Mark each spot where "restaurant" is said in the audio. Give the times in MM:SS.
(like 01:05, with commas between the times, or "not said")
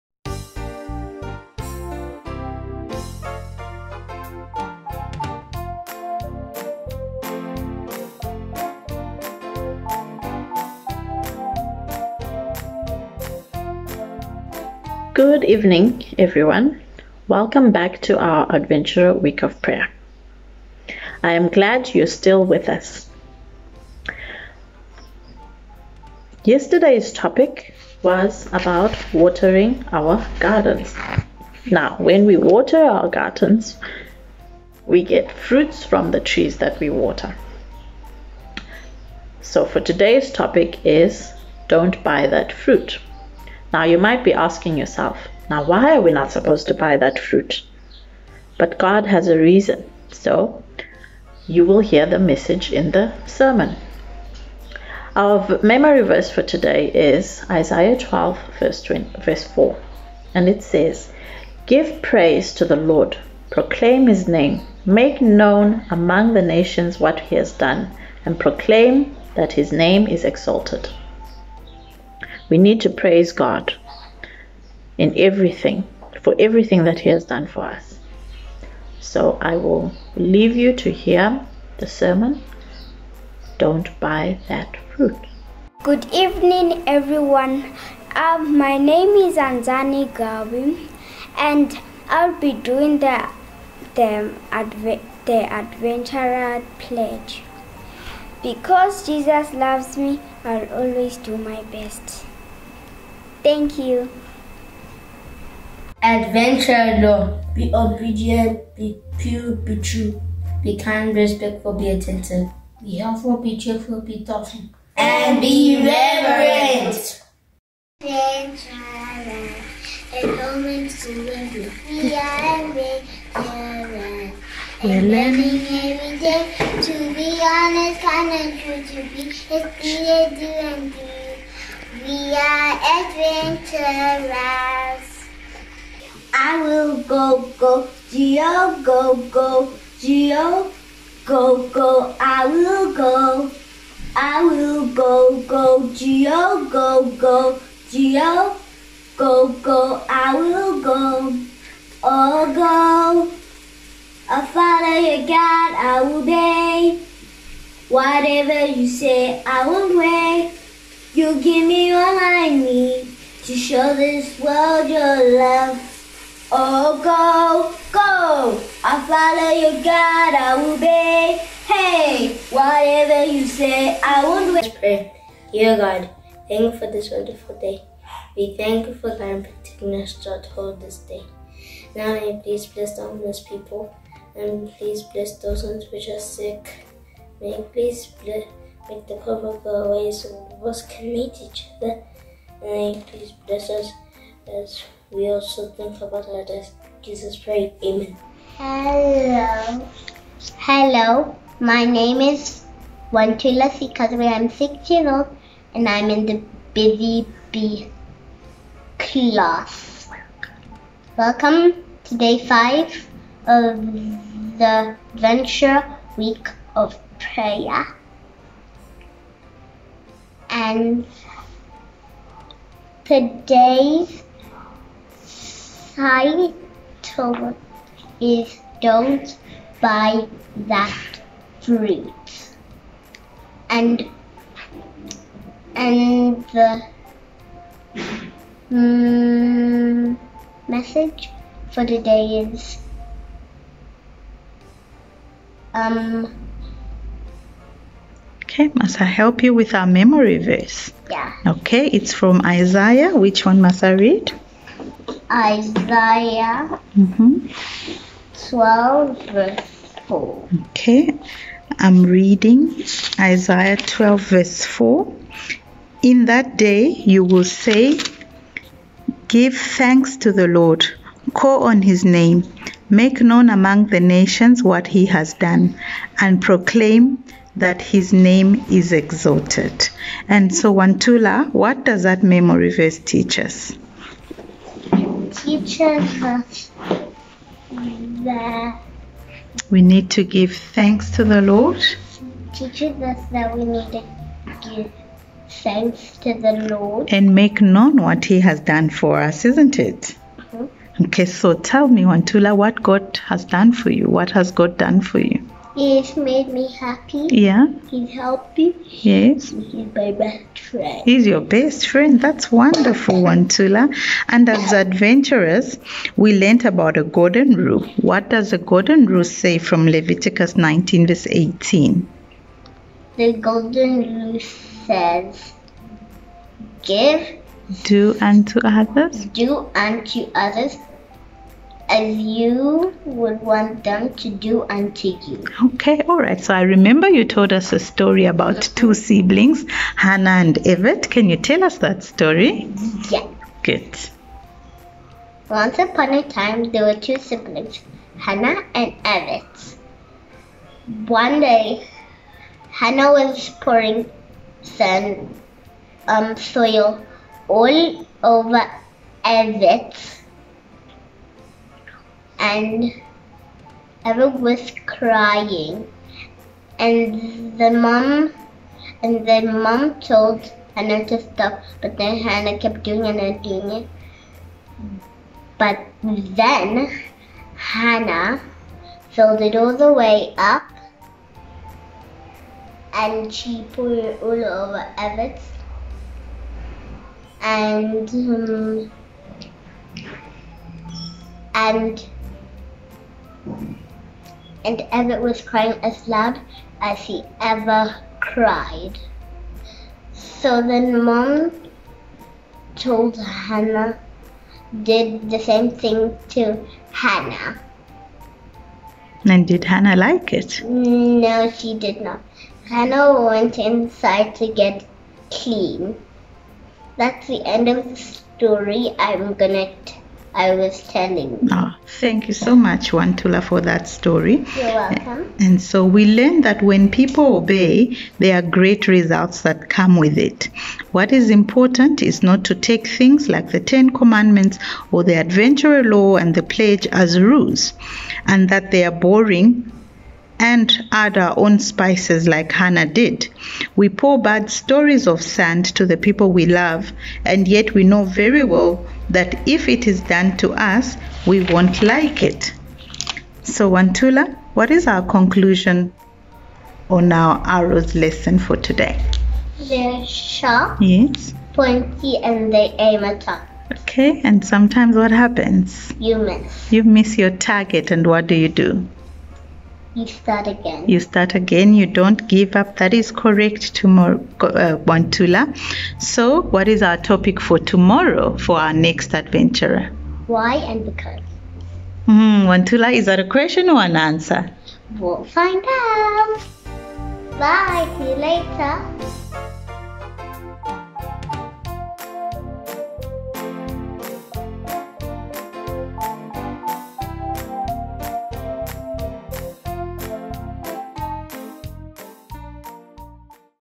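not said.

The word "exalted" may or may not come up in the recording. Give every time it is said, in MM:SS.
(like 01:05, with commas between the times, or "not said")
01:10, 04:38.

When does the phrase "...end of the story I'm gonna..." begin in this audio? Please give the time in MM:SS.
06:57.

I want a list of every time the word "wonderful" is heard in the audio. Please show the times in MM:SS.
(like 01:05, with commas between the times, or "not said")
02:57, 05:12.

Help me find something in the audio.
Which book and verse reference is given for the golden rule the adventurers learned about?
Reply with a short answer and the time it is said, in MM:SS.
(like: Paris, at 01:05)
Leviticus 19:18, at 05:19.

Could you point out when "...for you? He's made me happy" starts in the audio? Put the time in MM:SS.
05:05.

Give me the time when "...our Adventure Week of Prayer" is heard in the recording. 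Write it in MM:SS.
00:18.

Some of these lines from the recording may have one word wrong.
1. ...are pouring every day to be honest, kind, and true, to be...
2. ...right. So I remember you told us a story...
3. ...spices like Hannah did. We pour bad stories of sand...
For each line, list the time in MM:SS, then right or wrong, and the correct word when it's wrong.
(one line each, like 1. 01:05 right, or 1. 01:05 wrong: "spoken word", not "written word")
1. 02:04 wrong: "learning", not "pouring"
2. 05:36 right
3. 07:21 right.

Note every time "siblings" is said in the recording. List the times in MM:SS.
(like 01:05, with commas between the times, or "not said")
05:38, 05:47.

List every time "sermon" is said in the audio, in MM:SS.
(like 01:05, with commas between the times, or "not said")
00:53, 01:21.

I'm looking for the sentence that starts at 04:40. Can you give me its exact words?
And so, Wantula, what does that memory verse teach us?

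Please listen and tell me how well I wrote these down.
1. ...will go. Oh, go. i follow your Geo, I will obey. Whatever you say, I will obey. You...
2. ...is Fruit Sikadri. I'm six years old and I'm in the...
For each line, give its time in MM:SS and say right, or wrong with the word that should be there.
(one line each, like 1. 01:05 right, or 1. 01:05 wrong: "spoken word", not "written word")
1. 02:30 wrong: "God", not "Geo"
2. 03:22 wrong: "Wantula", not "Fruit".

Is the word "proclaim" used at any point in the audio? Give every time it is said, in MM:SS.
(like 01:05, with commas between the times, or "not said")
01:03, 01:08, 04:36.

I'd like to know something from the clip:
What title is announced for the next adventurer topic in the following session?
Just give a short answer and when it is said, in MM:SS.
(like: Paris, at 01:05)
Why and because, at 08:00.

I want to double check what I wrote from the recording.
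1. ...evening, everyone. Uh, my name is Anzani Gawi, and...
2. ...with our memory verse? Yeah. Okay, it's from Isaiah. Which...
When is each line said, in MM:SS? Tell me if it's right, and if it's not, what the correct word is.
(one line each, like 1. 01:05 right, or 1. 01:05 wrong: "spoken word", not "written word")
1. 01:26 right
2. 04:09 right.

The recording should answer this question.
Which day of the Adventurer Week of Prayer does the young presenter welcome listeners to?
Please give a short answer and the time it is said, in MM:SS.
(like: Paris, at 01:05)
Day 5, at 03:32.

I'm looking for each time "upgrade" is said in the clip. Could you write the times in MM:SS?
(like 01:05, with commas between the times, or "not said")
not said.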